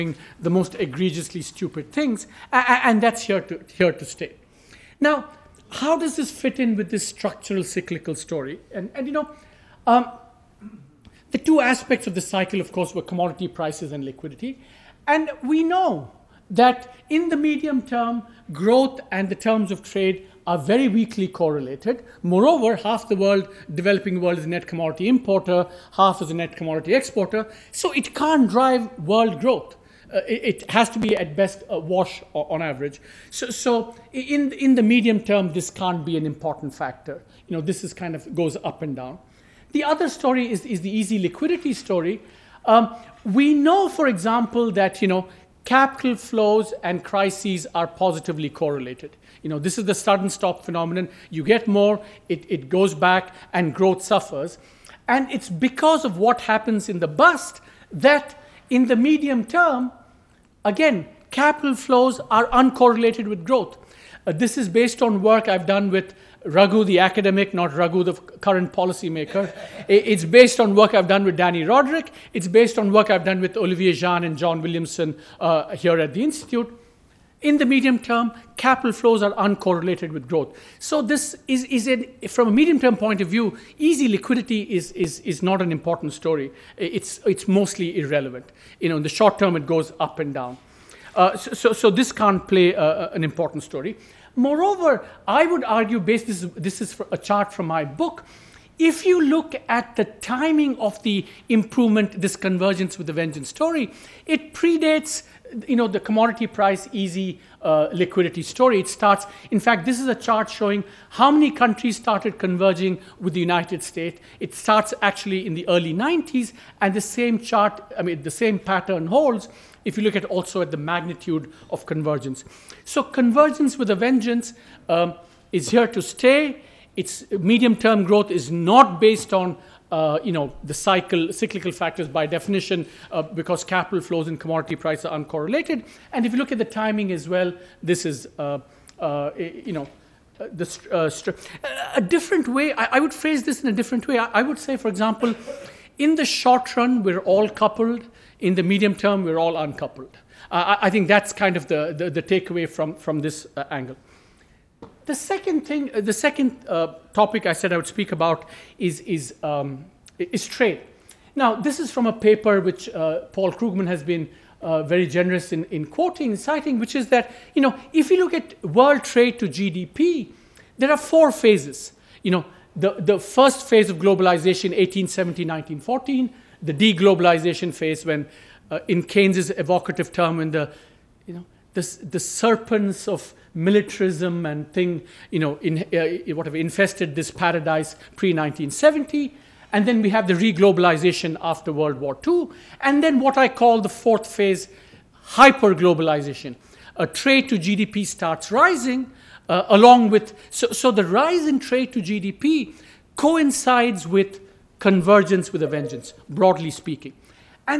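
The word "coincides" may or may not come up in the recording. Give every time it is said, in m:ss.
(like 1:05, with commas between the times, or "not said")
3:23.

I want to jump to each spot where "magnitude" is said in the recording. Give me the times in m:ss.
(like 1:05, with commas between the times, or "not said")
2:00.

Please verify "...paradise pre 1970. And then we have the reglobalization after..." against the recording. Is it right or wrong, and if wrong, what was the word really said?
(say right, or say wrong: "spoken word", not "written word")
right.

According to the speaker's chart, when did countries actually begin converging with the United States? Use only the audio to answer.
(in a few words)
Early 1990s.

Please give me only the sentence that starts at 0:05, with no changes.
Now, how does this fit in with this structural cyclical story?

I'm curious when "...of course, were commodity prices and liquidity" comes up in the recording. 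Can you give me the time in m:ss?
0:12.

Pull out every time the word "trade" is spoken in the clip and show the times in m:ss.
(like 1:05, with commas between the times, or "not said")
0:19, 2:40, 2:49, 3:17, 3:21.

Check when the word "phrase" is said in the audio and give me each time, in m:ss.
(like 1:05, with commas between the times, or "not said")
2:23.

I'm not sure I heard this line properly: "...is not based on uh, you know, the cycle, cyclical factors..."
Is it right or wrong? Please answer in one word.
right.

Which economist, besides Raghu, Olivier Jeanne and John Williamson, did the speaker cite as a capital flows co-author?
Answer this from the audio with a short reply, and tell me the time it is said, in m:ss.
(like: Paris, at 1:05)
Dani Rodrik, at 1:11.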